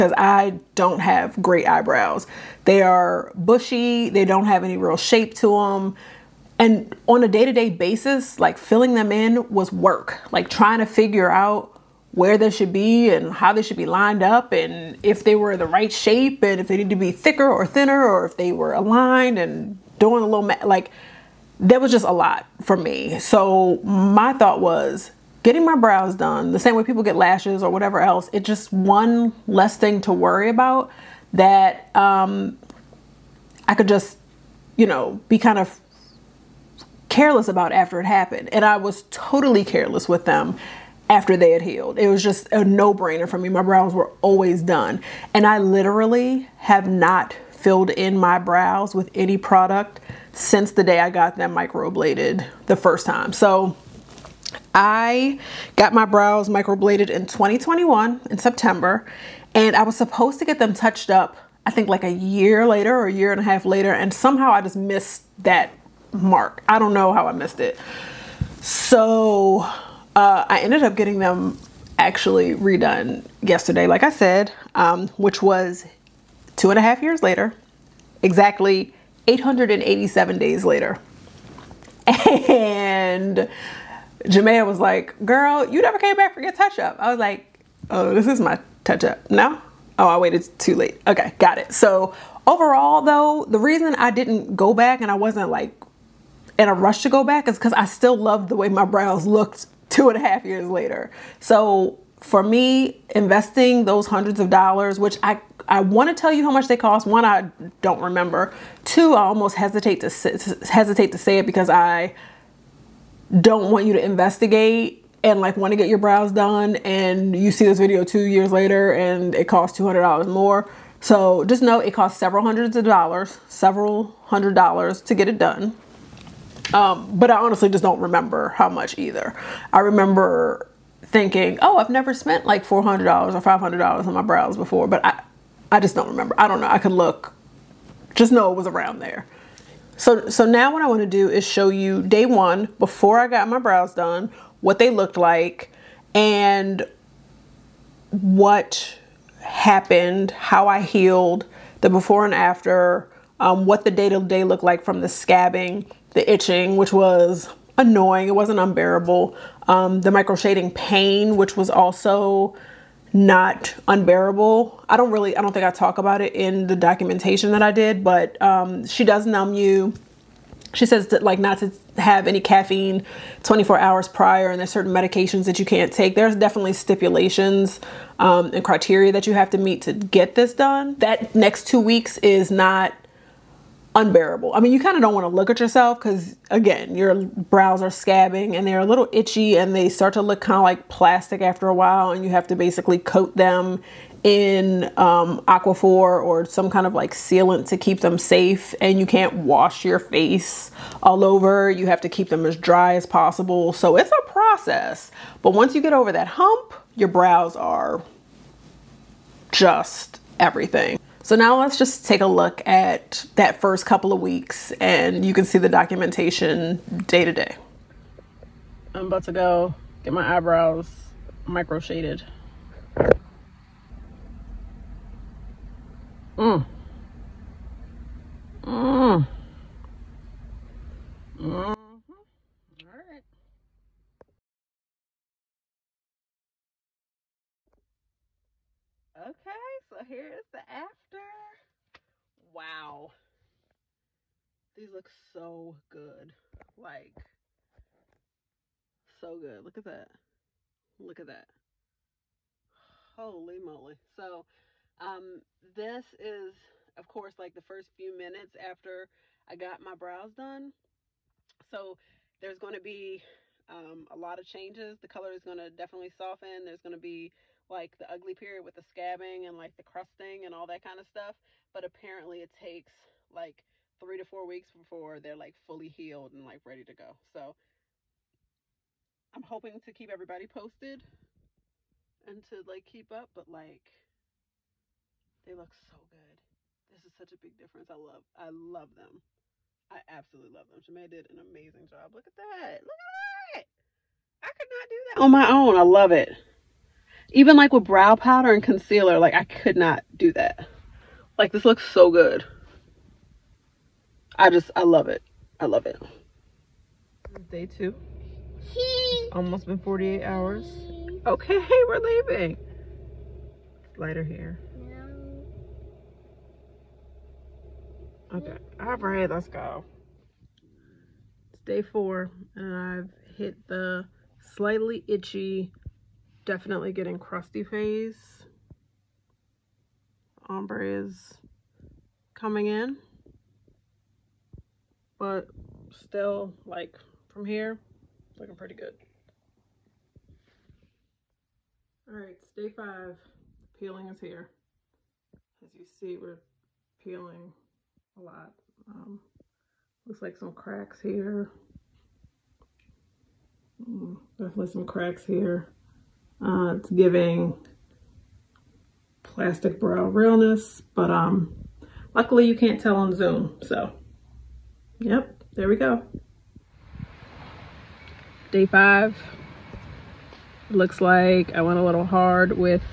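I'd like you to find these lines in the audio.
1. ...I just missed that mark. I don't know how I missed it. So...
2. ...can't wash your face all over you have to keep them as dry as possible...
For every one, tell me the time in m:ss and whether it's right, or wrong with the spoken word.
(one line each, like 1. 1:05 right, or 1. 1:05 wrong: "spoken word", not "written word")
1. 1:04 right
2. 3:19 right.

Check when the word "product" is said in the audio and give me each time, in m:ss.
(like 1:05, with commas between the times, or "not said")
0:49.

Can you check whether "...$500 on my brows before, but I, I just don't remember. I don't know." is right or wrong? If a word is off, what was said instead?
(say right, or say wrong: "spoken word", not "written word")
right.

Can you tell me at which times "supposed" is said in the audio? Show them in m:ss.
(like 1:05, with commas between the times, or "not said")
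0:59.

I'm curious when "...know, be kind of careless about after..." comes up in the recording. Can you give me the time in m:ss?
0:34.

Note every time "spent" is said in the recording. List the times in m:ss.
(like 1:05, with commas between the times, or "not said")
2:12.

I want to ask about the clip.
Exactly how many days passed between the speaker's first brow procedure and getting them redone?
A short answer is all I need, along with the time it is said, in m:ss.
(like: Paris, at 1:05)
887 days, at 1:19.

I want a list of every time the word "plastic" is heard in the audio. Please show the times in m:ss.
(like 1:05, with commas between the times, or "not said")
3:10, 5:59.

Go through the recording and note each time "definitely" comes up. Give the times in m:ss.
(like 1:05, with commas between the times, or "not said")
2:56, 4:25, 5:26, 5:54.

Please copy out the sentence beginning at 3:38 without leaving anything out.
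I'm about to go get my eyebrows micro shaded.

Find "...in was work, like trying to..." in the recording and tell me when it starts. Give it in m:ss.
0:09.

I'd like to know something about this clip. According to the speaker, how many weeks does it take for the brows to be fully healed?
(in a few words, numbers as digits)
3 to 4 weeks.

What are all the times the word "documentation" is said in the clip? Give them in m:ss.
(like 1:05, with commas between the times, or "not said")
2:46, 3:35.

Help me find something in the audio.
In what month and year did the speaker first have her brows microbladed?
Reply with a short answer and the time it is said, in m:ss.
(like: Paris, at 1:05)
September 2021, at 0:57.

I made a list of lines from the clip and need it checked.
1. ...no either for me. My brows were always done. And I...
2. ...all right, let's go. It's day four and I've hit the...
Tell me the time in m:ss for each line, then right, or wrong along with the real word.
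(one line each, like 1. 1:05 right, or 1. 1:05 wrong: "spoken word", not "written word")
1. 0:42 wrong: "brainer", not "either"
2. 5:18 right.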